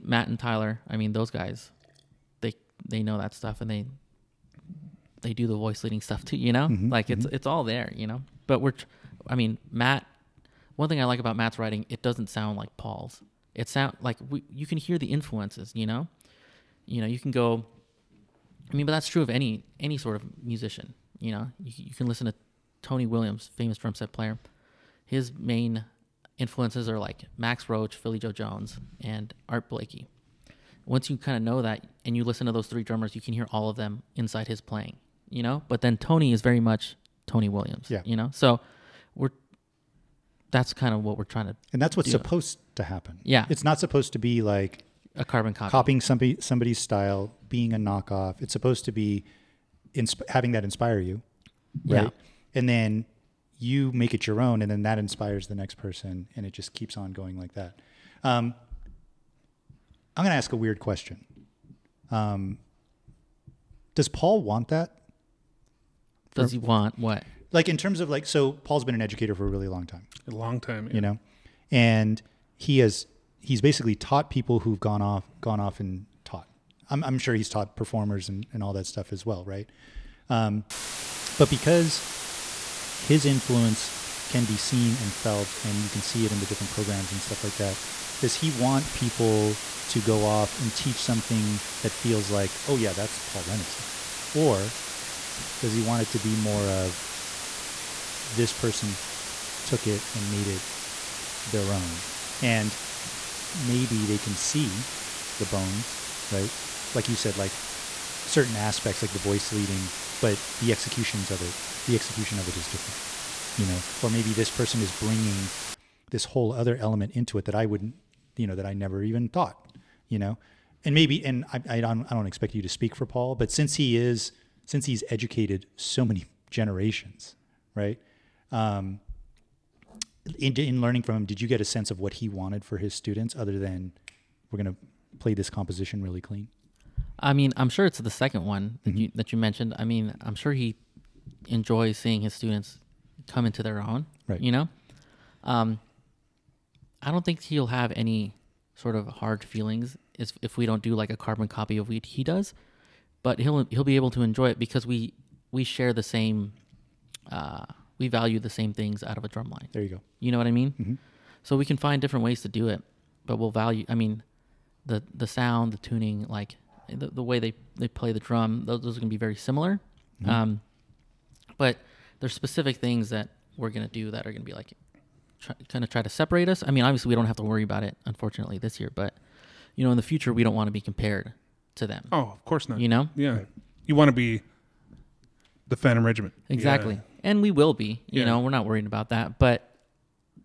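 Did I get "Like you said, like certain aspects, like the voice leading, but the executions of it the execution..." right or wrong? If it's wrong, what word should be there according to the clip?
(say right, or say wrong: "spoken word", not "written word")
right.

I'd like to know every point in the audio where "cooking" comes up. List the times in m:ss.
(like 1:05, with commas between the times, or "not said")
not said.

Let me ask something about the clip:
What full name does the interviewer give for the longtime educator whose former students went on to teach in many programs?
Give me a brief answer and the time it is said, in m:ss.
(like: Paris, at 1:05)
Paul Rennick, at 1:33.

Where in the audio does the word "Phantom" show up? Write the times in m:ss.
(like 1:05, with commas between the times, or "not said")
3:05.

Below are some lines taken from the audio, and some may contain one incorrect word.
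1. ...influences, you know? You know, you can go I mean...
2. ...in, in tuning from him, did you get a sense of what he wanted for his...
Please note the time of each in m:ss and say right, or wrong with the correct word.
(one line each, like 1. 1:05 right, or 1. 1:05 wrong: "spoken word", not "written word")
1. 0:15 right
2. 2:10 wrong: "learning", not "tuning".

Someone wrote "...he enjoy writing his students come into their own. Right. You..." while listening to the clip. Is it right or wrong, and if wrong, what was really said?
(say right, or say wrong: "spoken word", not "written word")
wrong: "seeing", not "writing".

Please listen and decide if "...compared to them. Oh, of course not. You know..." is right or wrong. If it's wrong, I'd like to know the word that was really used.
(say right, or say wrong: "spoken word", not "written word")
right.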